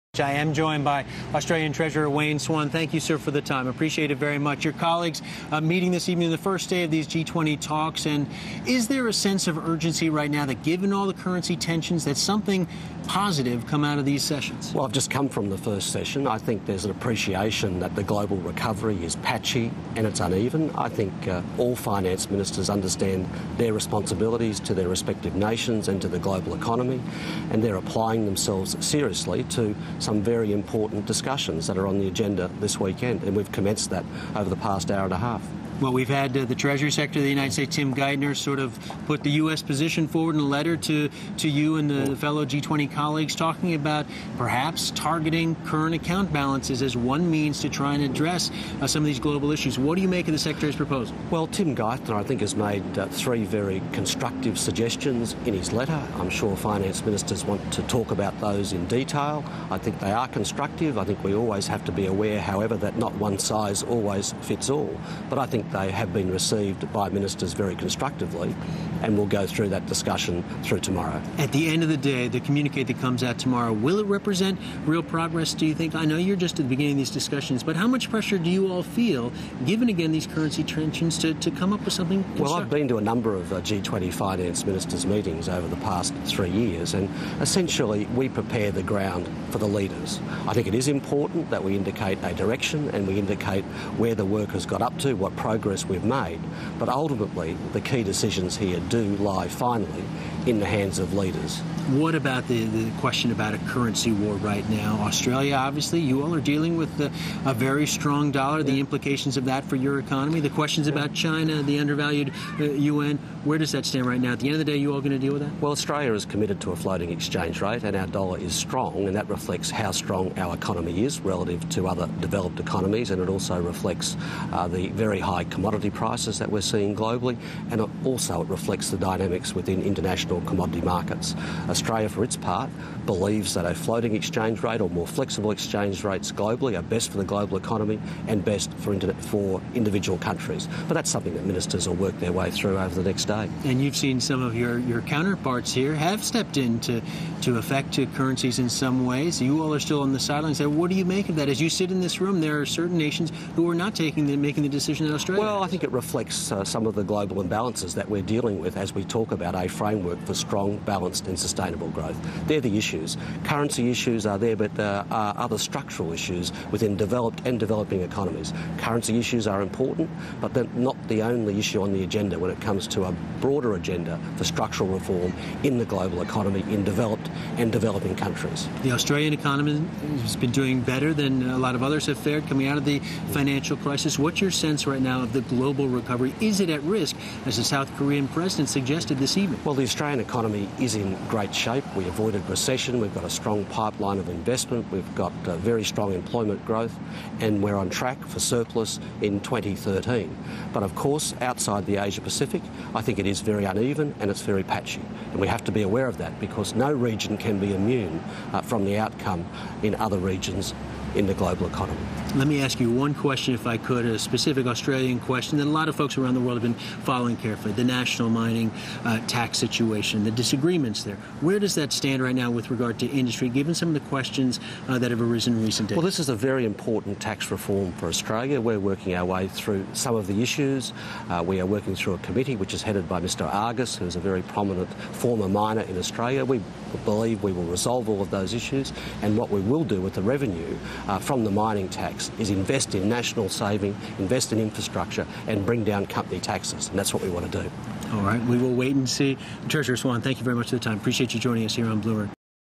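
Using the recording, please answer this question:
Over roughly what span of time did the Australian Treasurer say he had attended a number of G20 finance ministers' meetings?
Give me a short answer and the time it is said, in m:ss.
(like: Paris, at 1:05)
3 years, at 1:26.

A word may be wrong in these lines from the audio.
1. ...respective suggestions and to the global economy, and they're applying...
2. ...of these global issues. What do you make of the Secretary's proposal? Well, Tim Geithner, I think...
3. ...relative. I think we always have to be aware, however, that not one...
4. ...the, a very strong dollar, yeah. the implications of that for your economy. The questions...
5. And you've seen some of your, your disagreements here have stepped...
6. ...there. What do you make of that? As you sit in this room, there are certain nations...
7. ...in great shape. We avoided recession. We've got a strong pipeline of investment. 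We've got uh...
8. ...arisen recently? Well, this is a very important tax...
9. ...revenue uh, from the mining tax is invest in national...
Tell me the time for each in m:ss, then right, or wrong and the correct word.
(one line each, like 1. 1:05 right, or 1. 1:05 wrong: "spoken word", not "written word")
1. 0:24 wrong: "nations", not "suggestions"
2. 0:49 right
3. 1:00 wrong: "constructive", not "relative"
4. 1:46 right
5. 2:23 wrong: "counterparts", not "disagreements"
6. 2:30 right
7. 3:10 right
8. 3:45 right
9. 4:00 right.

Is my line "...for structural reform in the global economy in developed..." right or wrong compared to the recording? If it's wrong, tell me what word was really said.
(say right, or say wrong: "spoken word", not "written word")
right.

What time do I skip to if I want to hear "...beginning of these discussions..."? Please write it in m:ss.
1:16.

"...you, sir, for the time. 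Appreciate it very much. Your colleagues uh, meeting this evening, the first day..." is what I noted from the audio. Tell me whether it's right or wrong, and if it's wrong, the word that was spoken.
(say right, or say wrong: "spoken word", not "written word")
right.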